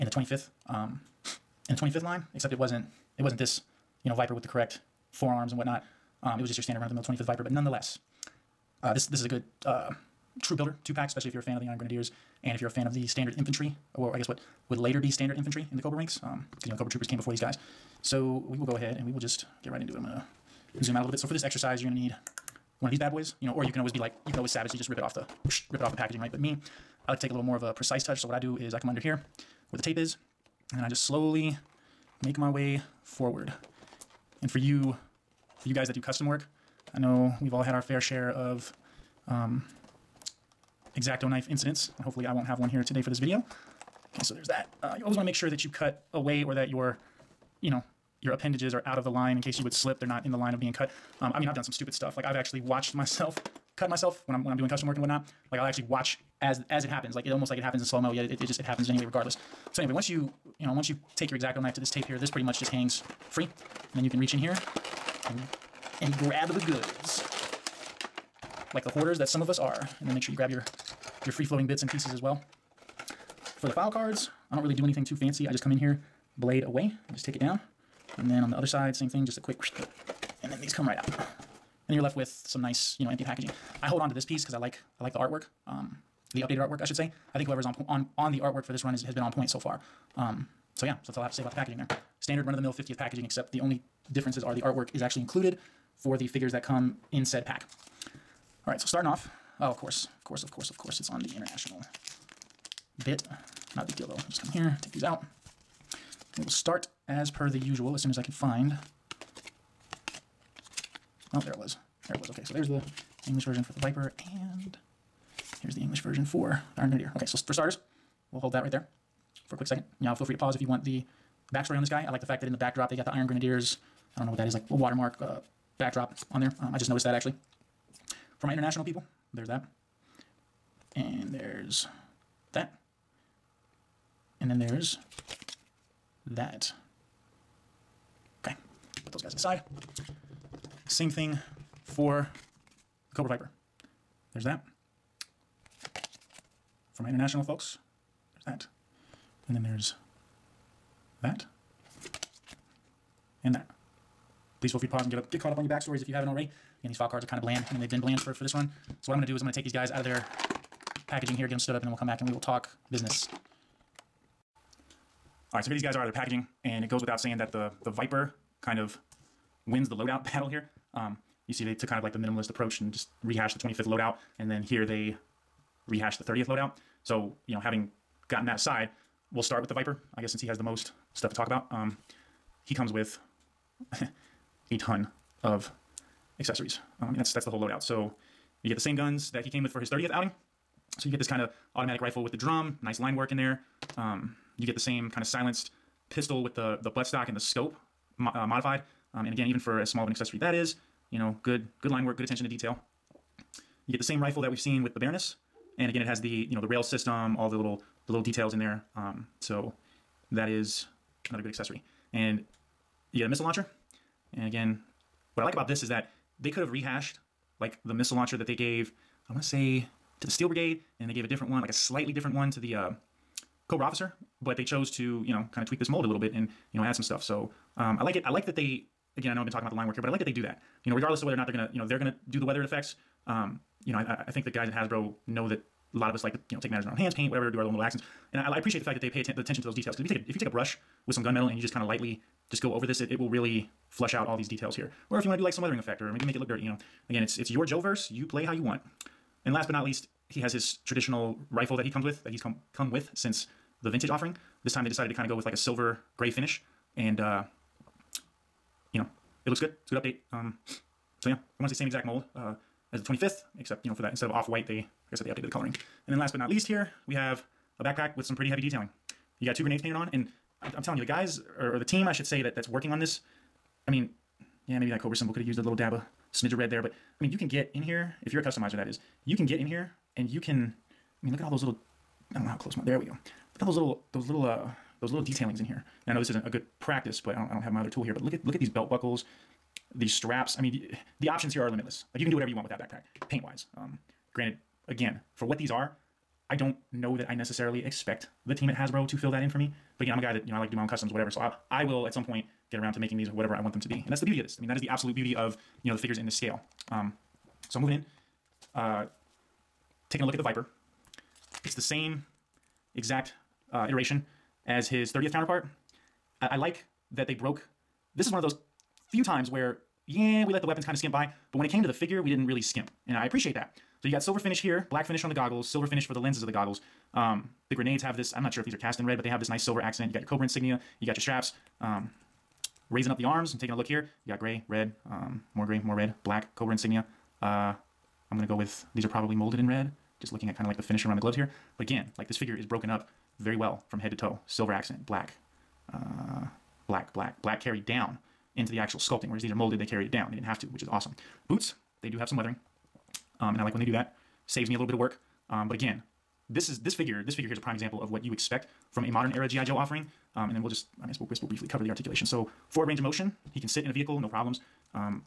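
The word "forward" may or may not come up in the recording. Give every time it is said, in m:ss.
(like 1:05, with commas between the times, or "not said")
0:33, 6:02.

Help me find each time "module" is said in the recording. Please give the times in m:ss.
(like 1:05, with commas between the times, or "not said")
not said.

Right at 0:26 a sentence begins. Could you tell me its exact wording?
But me, I like to take a little more of a precise touch.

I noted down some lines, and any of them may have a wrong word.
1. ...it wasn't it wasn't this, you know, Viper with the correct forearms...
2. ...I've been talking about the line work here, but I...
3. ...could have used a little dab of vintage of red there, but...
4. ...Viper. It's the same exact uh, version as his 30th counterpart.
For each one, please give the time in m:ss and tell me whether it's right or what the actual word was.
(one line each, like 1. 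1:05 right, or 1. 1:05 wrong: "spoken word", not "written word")
1. 0:02 right
2. 3:49 right
3. 4:35 wrong: "smidge", not "vintage"
4. 5:10 wrong: "iteration", not "version".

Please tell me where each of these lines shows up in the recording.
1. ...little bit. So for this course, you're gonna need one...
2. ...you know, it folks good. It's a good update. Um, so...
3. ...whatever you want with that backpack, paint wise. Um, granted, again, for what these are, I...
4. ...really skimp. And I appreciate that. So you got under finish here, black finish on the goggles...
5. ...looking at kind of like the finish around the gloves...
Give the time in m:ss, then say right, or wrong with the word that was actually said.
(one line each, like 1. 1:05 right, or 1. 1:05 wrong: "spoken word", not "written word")
1. 0:21 wrong: "exercise", not "course"
2. 4:18 wrong: "looks", not "folks"
3. 4:52 right
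4. 5:22 wrong: "silver", not "under"
5. 5:40 right.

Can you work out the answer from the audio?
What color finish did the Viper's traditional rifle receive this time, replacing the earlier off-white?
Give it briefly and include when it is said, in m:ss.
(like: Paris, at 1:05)
Silver gray, at 4:15.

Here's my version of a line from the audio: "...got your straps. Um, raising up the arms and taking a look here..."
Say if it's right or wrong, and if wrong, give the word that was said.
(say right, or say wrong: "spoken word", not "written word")
right.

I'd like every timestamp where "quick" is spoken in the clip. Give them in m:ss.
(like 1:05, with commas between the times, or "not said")
1:19, 1:59.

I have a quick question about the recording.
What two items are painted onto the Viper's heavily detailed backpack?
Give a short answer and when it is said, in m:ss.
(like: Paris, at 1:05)
Two grenades, at 4:29.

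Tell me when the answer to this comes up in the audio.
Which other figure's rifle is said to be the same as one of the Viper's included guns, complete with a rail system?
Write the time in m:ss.
3:24.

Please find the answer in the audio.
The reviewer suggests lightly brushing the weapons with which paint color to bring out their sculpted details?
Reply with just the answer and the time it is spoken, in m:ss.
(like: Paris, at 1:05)
Gunmetal, at 4:01.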